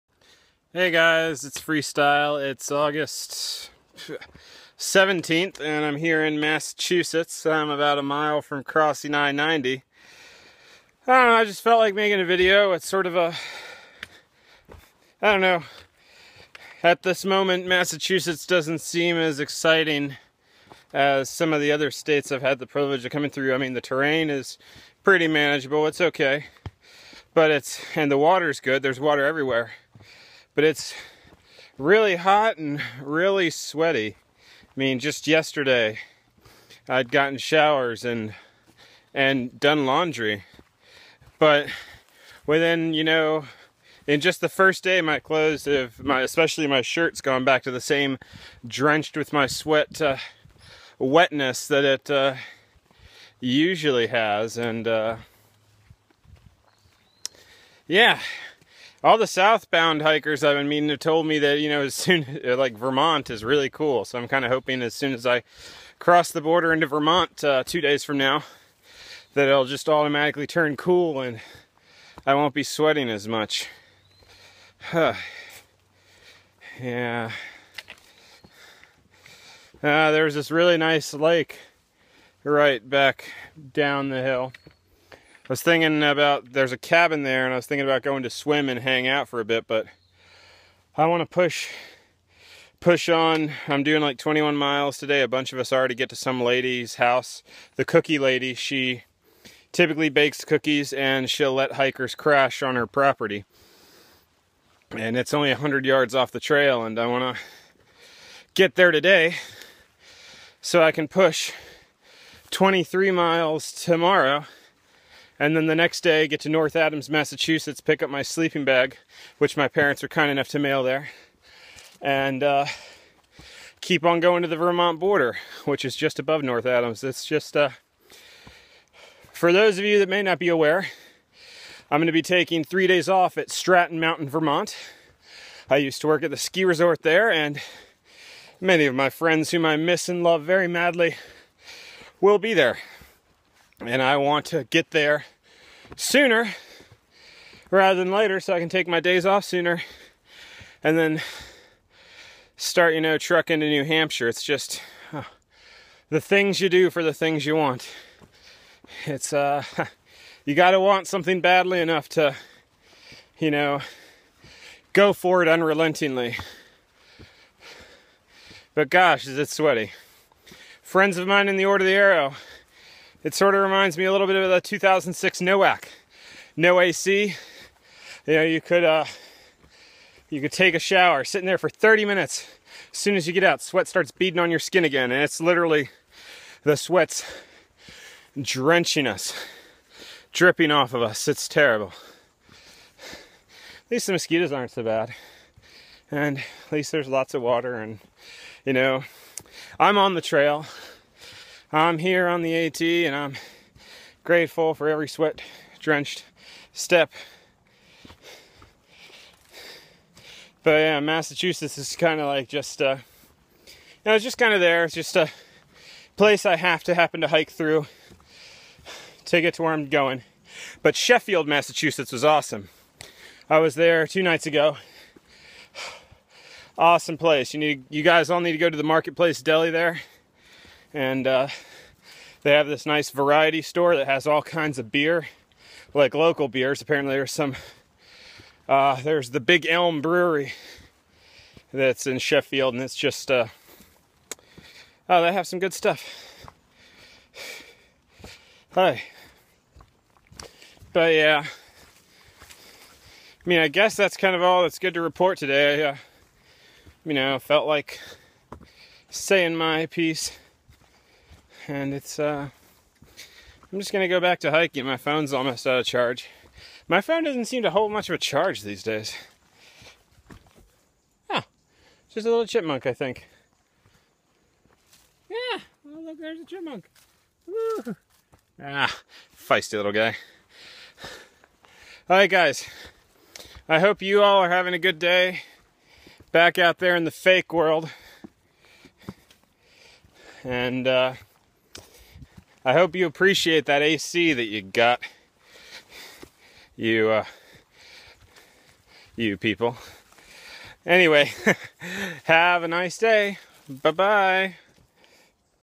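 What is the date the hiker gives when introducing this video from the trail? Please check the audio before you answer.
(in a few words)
August 17.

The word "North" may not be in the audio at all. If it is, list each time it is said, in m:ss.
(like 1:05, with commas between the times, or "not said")
1:56, 2:06.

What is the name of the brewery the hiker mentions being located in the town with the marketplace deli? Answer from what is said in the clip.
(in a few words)
Big Elm Brewery.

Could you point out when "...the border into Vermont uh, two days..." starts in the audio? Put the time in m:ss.
1:06.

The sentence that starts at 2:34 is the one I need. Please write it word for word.
It's just oh, the things you do for the things you want.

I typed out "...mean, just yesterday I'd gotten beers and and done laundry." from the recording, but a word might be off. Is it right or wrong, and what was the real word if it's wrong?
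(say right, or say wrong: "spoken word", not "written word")
wrong: "showers", not "beers".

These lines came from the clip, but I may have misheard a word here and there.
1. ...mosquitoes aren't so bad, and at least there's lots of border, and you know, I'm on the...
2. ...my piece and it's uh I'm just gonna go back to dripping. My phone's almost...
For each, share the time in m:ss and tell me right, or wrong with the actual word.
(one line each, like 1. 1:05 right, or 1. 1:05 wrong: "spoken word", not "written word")
1. 3:14 wrong: "water", not "border"
2. 4:19 wrong: "hiking", not "dripping".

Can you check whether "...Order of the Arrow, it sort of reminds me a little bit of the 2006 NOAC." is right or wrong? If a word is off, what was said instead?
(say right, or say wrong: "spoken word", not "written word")
right.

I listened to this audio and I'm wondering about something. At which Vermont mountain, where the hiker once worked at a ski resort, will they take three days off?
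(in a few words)
Stratton Mountain.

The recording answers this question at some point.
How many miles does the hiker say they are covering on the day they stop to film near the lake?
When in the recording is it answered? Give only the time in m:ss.
1:34.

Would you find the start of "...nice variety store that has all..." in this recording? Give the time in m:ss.
3:52.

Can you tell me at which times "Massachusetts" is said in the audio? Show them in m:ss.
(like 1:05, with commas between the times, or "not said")
0:06, 0:17, 1:57, 3:30, 3:41.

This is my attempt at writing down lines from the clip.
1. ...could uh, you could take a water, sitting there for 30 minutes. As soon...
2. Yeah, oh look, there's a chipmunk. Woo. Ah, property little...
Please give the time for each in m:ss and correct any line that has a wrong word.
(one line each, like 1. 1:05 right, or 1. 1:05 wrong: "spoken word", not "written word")
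1. 2:58 wrong: "shower", not "water"
2. 4:35 wrong: "feisty", not "property".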